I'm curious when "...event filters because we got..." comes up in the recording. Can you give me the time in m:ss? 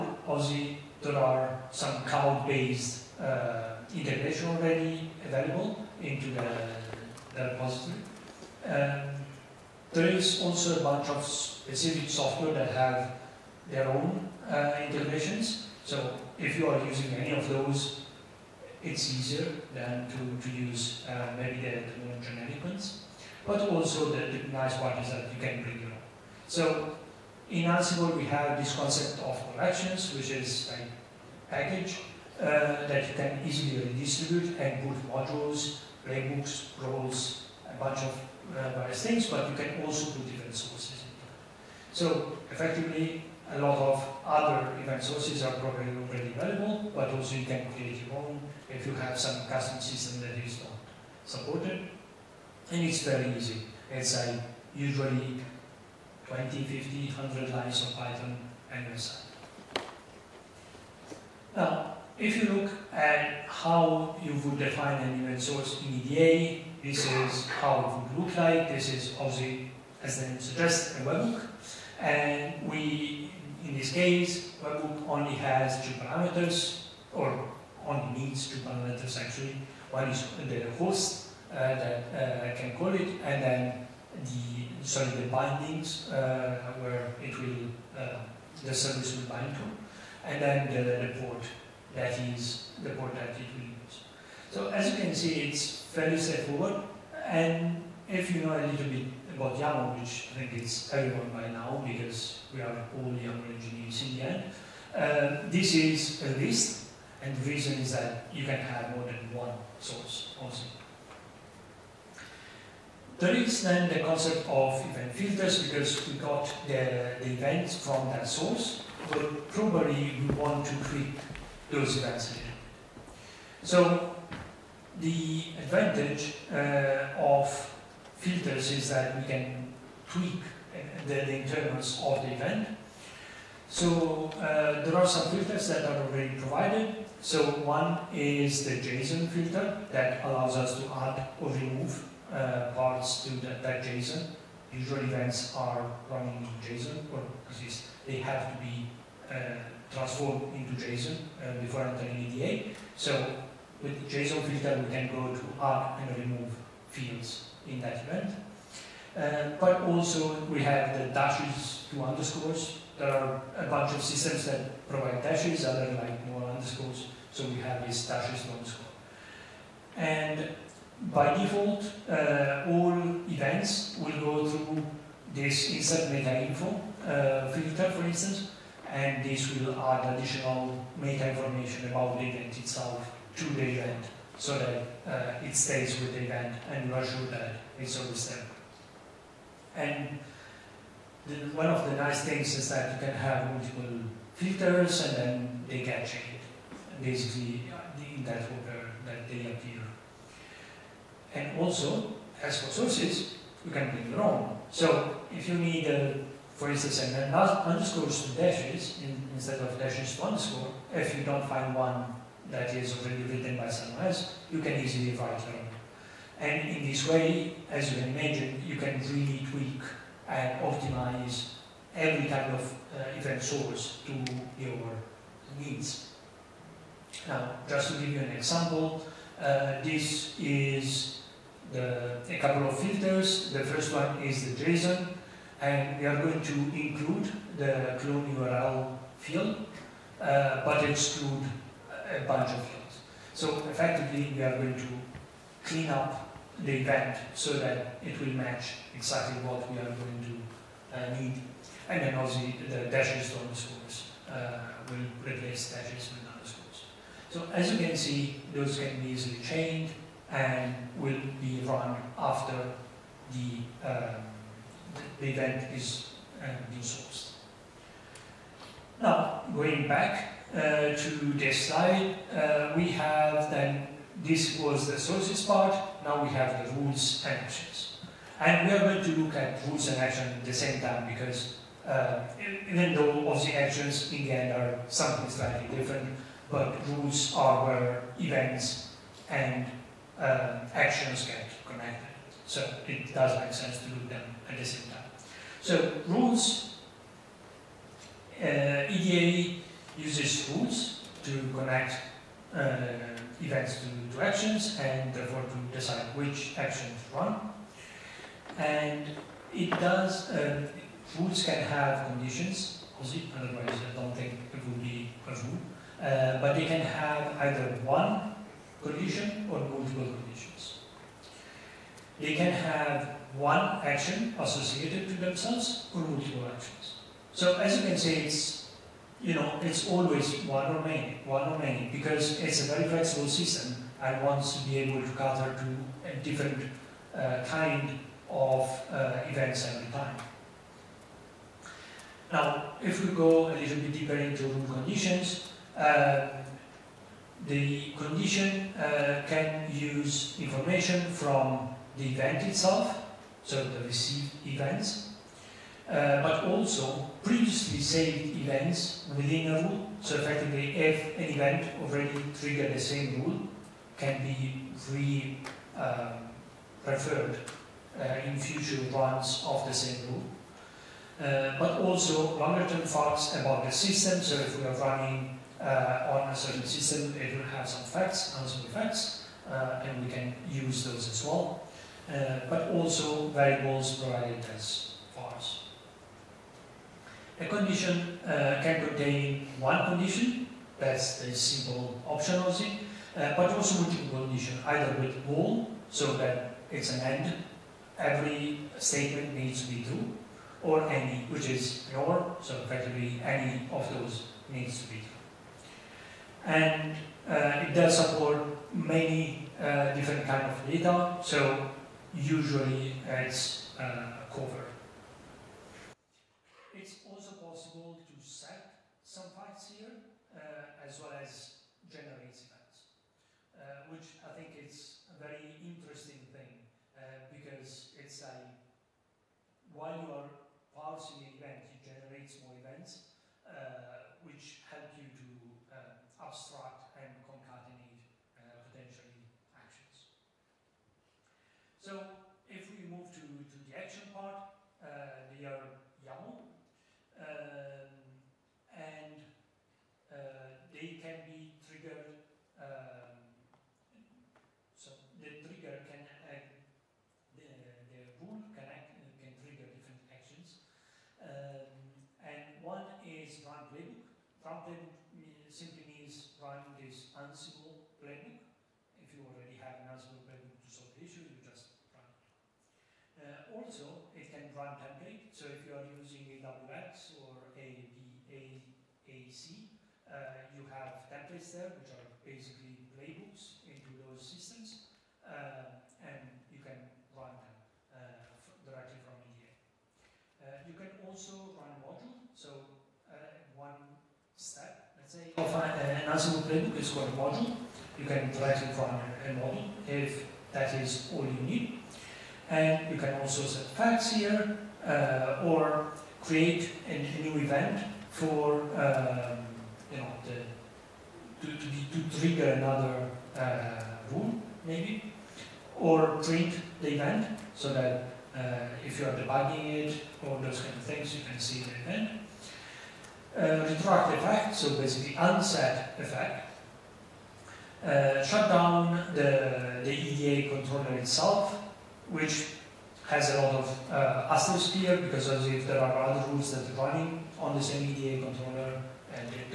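1:54.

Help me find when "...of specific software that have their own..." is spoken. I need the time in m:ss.
0:11.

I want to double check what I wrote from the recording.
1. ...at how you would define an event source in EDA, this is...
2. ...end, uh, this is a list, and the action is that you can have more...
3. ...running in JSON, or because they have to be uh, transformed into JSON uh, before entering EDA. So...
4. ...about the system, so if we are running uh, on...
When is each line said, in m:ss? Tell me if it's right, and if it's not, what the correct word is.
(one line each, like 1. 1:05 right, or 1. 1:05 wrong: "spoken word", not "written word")
1. 1:02 right
2. 1:44 wrong: "reason", not "action"
3. 2:26 right
4. 6:13 right.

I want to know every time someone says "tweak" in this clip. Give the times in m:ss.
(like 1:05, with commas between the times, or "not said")
2:10, 3:39.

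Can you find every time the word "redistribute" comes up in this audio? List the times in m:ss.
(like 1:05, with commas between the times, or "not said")
0:33.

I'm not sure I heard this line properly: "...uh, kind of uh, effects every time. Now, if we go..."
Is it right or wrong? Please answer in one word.
wrong.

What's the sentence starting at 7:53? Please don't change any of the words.
Uh, also, it can run template.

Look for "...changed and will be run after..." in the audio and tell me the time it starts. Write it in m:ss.
4:19.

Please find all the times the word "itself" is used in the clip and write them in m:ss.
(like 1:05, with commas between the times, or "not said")
3:02, 5:52, 8:50.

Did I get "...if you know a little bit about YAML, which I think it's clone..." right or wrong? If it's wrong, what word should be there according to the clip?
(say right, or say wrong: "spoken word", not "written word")
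wrong: "everyone", not "clone".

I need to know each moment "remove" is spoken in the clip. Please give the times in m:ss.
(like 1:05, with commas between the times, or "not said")
2:21, 2:36.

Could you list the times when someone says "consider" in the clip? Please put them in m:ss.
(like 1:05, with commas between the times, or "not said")
not said.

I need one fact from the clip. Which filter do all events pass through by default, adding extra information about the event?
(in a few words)
insert meta info.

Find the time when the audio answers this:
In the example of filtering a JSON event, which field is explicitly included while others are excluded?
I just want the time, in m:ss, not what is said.
3:57.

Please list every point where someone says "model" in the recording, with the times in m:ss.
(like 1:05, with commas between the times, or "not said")
8:19.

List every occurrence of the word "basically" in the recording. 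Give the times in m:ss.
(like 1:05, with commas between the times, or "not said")
3:17, 8:02, 8:44.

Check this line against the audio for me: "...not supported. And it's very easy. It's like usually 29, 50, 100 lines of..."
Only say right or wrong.
wrong.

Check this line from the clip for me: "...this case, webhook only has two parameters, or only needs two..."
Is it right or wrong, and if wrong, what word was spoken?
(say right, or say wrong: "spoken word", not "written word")
right.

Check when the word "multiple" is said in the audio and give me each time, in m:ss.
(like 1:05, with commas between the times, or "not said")
3:13, 5:19, 5:26, 6:33.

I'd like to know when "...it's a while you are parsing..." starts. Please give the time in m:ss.
7:07.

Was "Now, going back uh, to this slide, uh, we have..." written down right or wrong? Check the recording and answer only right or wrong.
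right.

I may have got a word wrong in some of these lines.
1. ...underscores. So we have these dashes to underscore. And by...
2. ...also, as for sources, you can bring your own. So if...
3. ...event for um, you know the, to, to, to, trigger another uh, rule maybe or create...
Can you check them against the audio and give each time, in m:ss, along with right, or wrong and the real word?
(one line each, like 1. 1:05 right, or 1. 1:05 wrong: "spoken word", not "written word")
1. 2:46 right
2. 3:21 right
3. 8:27 right.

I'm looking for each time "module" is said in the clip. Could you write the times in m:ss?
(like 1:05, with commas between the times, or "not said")
0:35, 8:11, 8:17.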